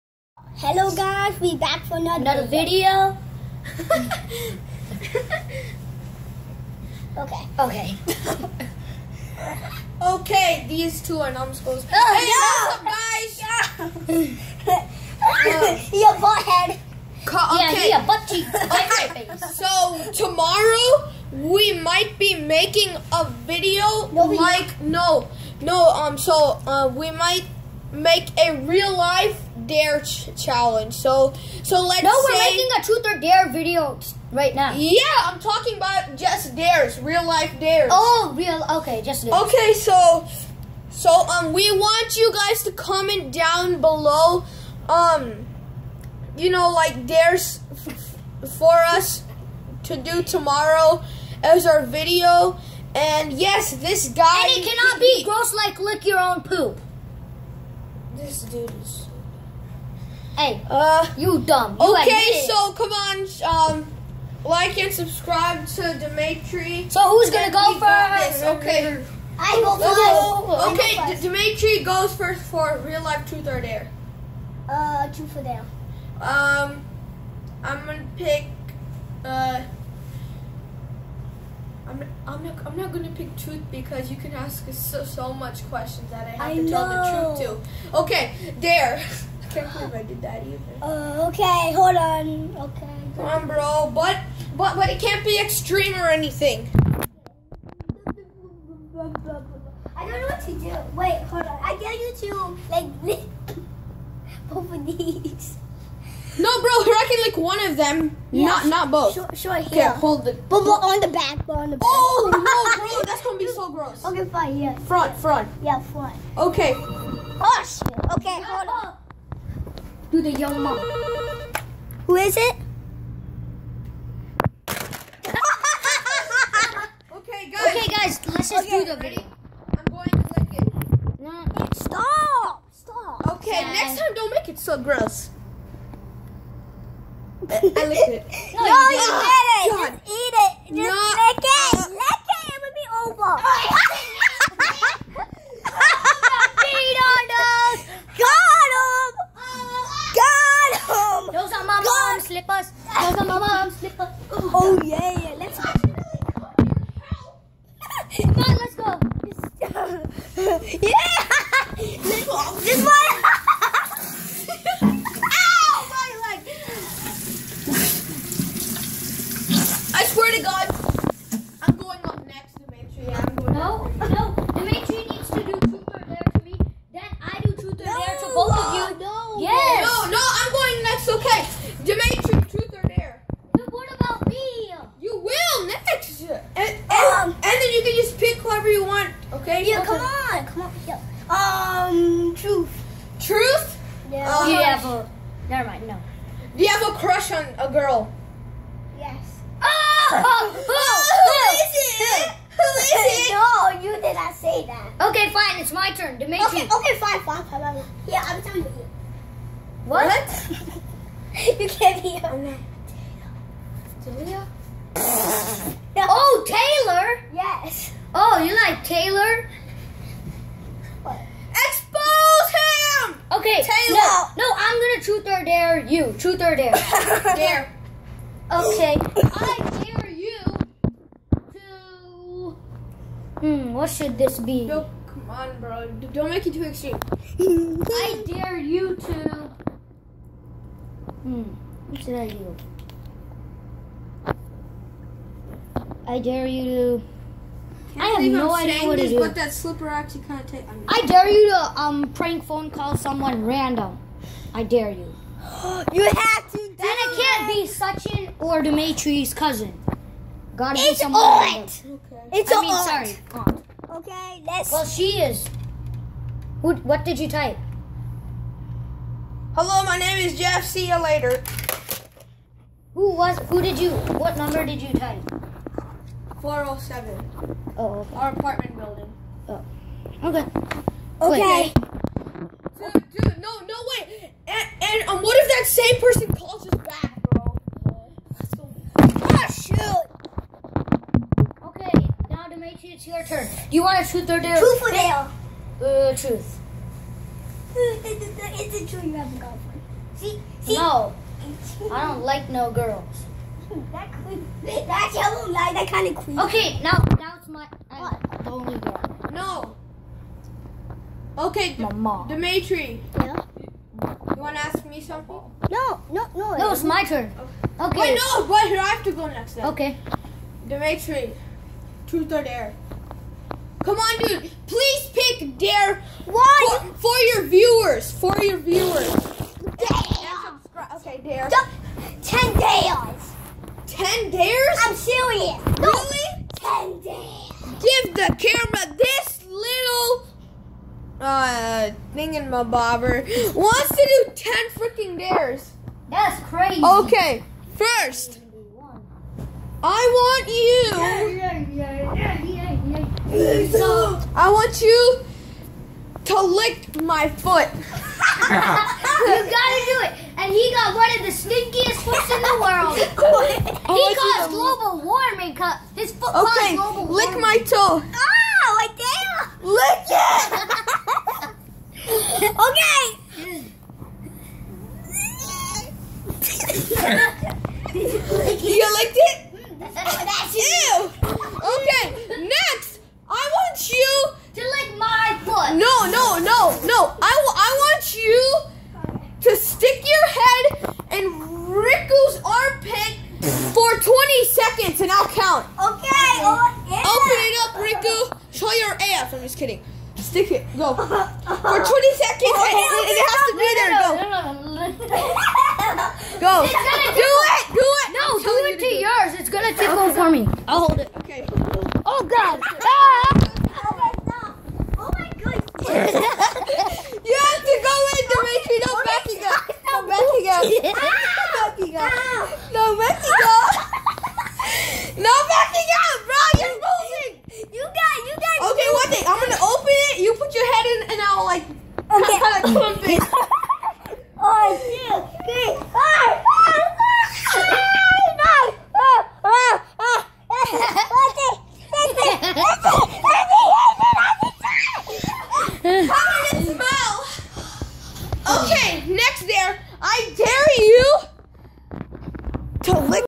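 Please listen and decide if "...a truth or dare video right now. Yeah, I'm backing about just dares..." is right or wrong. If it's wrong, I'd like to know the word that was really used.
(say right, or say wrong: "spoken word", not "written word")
wrong: "talking", not "backing".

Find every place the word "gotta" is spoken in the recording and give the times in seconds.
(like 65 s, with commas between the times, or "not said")
260 s, 358 s.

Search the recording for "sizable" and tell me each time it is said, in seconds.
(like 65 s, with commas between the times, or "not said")
not said.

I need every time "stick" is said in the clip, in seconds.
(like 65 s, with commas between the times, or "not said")
389 s, 400 s.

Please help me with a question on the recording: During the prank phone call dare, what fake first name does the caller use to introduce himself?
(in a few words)
Jeff.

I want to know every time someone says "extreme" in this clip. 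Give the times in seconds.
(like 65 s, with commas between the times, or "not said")
95 s, 236 s.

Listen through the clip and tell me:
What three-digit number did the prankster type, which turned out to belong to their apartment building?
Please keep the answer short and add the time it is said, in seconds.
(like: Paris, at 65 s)
407, at 276 s.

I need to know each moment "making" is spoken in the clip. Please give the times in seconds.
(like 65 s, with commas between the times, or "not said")
22 s, 32 s.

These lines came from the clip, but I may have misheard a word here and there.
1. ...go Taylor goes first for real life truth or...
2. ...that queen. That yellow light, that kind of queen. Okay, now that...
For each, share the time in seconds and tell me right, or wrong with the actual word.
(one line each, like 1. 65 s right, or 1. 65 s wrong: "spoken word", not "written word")
1. 71 s wrong: "Dimitri", not "Taylor"
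2. 303 s right.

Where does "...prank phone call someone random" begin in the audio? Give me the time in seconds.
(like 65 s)
252 s.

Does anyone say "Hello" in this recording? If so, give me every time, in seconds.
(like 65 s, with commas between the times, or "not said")
0 s, 269 s.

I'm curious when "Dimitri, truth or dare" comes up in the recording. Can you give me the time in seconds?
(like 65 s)
320 s.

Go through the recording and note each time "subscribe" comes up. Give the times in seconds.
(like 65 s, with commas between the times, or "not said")
64 s.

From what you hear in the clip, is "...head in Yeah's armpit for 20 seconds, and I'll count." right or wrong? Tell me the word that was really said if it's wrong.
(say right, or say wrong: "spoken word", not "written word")
wrong: "Ricko", not "Yeah".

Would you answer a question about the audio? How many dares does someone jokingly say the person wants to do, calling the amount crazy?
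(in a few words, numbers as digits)
10.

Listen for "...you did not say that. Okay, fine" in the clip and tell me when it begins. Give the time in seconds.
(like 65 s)
203 s.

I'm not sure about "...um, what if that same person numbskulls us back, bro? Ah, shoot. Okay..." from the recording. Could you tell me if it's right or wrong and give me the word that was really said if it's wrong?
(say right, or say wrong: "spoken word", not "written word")
wrong: "calls", not "numbskulls".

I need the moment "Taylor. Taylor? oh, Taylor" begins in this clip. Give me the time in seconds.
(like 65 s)
214 s.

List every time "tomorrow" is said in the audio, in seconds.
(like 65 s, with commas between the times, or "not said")
20 s, 50 s.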